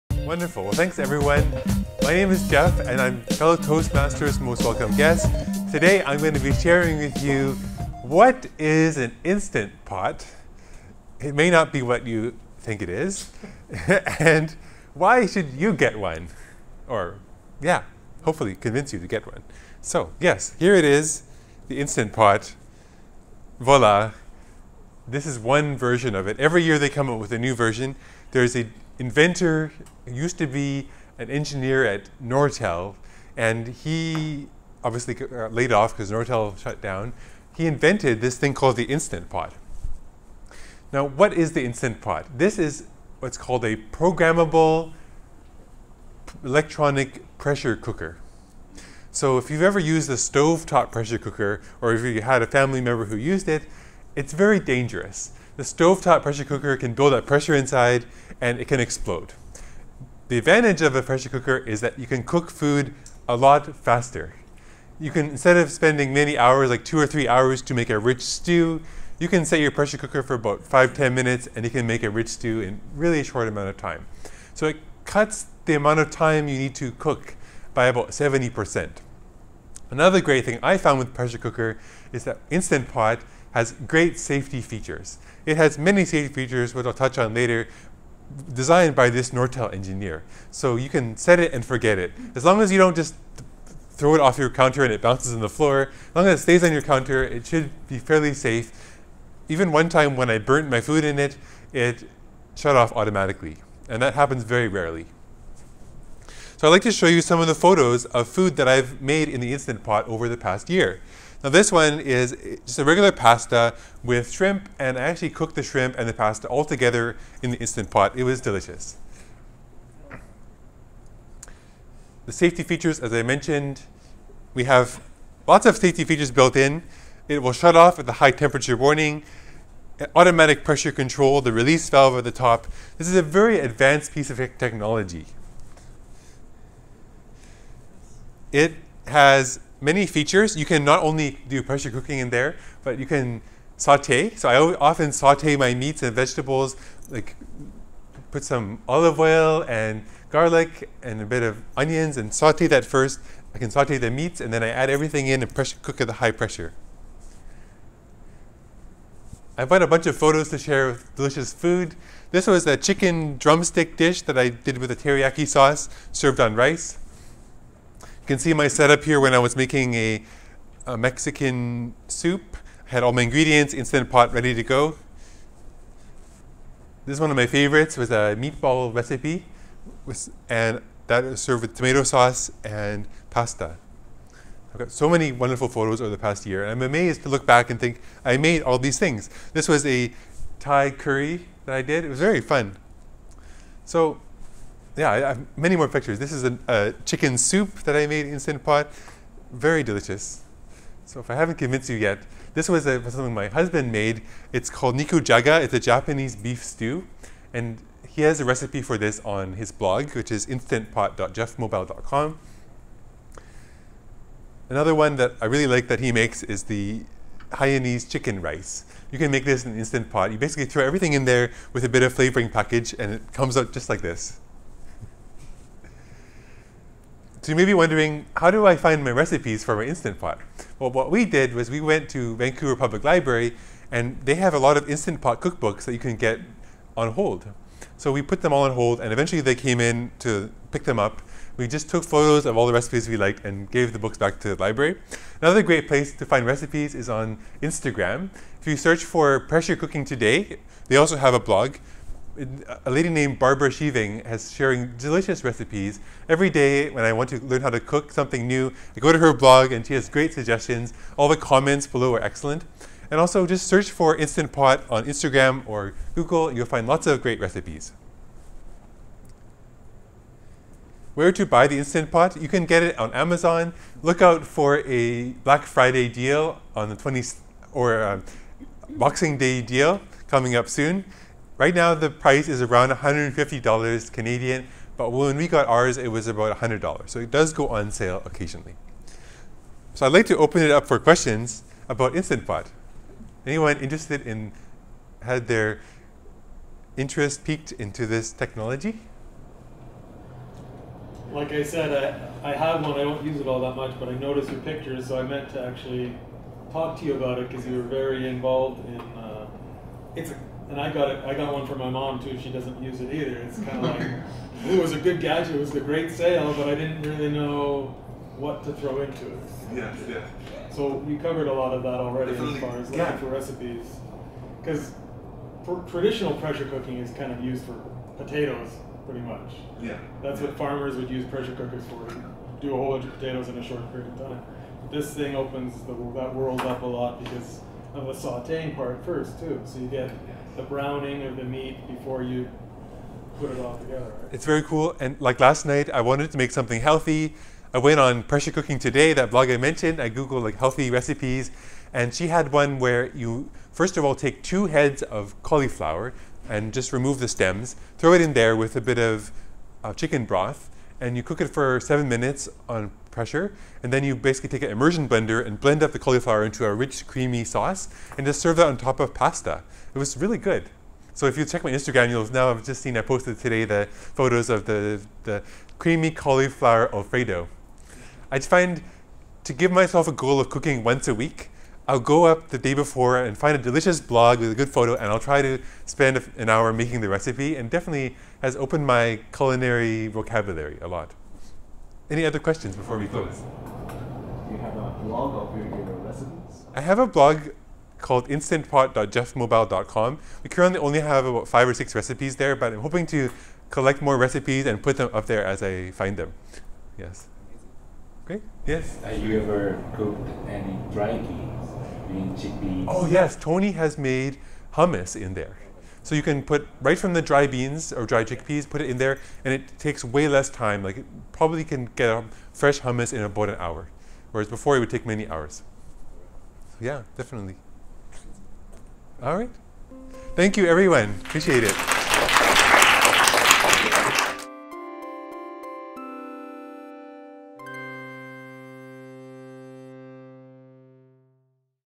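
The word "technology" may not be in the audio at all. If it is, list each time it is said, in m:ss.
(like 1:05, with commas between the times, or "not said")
2:14, 4:58.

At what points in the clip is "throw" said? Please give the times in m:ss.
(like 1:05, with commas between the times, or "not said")
1:33, 3:40, 5:18, 5:57.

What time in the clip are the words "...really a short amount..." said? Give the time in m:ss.
1:12.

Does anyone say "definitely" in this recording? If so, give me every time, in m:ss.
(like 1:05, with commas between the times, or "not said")
5:22, 6:27, 7:07.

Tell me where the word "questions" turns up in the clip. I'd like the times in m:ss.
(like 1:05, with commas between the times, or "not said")
4:50, 6:32.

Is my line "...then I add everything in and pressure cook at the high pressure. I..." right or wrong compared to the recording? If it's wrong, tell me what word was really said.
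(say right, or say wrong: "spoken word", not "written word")
right.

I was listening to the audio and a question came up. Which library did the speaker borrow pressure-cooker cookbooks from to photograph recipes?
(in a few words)
Vancouver Public Library.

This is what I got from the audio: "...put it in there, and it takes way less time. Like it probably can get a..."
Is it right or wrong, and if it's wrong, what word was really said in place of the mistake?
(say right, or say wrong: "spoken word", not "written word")
right.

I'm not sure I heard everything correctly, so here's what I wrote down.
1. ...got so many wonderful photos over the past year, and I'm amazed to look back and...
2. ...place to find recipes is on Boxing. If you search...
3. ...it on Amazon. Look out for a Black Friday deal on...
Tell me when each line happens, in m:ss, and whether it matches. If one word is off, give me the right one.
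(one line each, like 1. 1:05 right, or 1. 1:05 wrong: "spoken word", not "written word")
1. 3:04 right
2. 4:05 wrong: "Instagram", not "Boxing"
3. 4:32 right.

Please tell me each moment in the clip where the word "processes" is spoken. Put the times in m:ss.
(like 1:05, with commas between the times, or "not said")
not said.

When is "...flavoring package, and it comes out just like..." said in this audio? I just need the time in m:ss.
3:42.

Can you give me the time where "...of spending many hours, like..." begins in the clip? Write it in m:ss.
1:05.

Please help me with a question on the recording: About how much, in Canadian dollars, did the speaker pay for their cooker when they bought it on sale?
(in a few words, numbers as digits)
$100.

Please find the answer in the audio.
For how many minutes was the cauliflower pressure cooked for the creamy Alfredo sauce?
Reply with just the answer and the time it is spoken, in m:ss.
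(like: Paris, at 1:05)
7 minutes, at 6:01.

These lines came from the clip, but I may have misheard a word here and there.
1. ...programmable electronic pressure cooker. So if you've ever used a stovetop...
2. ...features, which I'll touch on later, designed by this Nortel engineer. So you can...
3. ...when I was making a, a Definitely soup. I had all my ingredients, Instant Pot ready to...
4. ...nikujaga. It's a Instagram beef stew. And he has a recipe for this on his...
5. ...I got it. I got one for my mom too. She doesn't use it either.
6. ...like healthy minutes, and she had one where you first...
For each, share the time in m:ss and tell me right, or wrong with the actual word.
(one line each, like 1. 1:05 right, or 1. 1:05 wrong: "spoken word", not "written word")
1. 0:43 right
2. 1:26 right
3. 2:49 wrong: "Mexican", not "Definitely"
4. 3:24 wrong: "Japanese", not "Instagram"
5. 5:10 right
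6. 5:50 wrong: "recipes", not "minutes".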